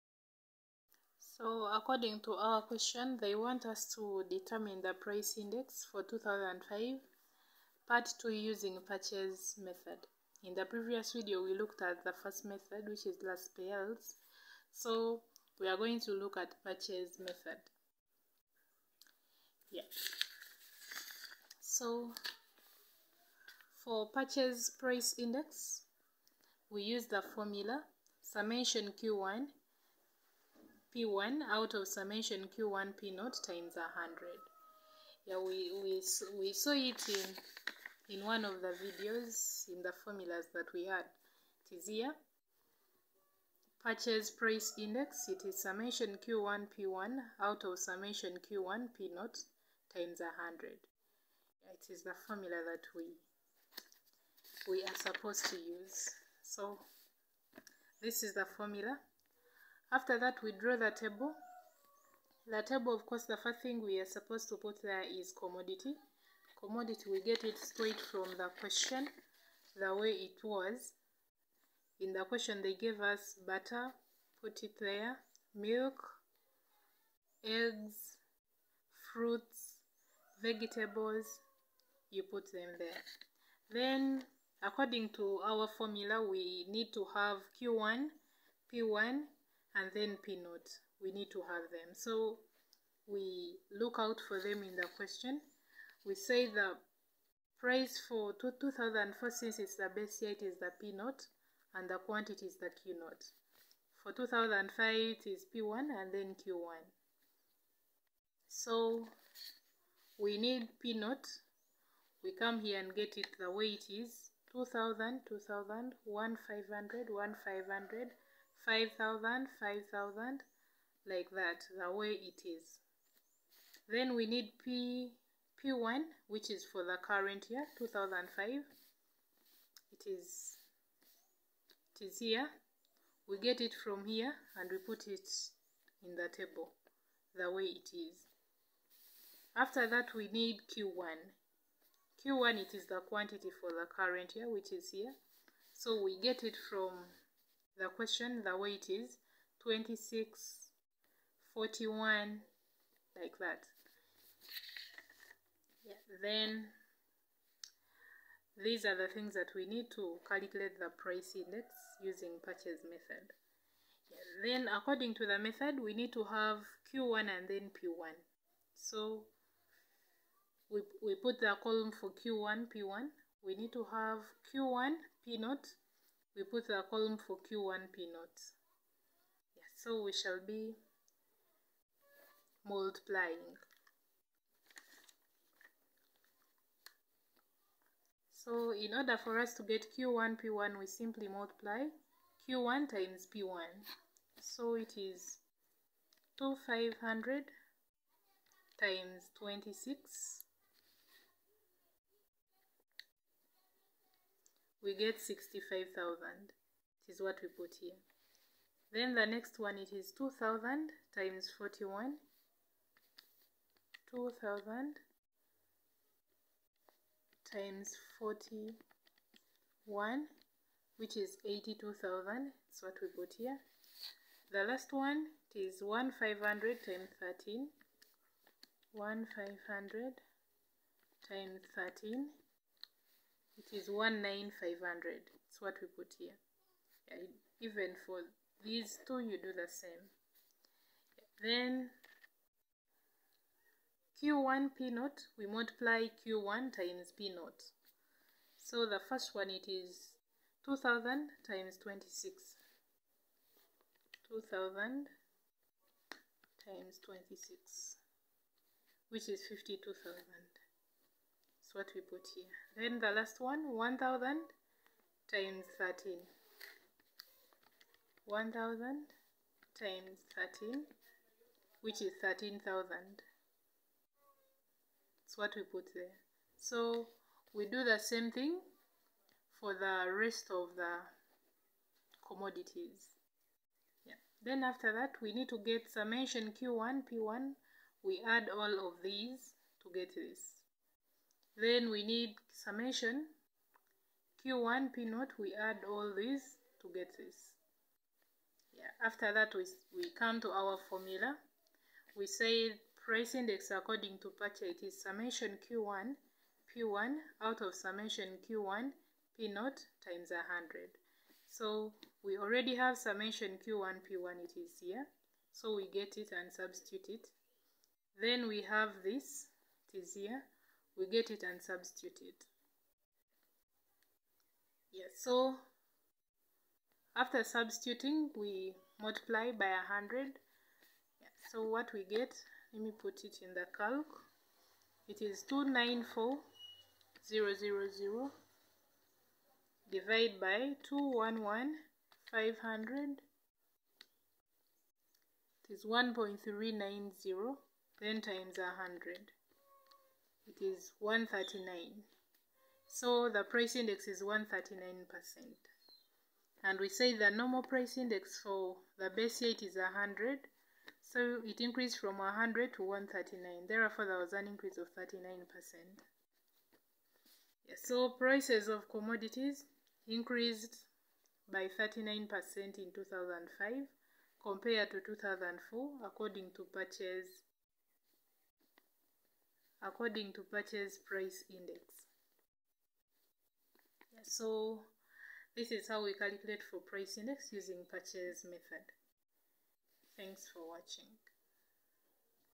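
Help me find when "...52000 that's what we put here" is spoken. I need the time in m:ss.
4:19.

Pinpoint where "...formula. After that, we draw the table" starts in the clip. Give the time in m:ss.
0:58.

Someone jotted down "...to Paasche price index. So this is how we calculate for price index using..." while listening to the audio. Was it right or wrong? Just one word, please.
right.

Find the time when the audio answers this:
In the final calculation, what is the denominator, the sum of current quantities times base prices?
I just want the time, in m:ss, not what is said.
5:40.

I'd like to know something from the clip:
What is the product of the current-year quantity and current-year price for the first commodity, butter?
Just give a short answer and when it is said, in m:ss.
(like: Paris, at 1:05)
65,000, at 3:25.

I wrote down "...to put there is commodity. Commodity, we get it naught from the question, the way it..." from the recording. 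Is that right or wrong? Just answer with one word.
wrong.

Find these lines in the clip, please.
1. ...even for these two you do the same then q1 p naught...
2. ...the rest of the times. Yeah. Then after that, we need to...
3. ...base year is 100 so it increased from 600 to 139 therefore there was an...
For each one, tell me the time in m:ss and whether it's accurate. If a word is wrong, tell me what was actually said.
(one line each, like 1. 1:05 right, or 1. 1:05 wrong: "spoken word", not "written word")
1. 3:57 right
2. 4:39 wrong: "commodities", not "times"
3. 5:59 wrong: "100", not "600".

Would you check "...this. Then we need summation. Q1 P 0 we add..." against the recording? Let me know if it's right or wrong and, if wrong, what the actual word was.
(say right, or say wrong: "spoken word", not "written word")
right.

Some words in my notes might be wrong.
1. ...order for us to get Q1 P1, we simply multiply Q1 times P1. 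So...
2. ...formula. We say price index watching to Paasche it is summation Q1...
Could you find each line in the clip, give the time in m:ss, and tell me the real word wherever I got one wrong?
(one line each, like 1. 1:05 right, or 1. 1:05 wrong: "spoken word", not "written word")
1. 3:08 right
2. 5:00 wrong: "according", not "watching".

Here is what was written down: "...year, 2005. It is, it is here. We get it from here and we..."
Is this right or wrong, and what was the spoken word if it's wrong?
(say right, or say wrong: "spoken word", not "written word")
right.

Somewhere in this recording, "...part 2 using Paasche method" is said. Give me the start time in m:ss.
0:07.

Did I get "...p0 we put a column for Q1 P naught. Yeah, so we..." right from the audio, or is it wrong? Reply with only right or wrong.
right.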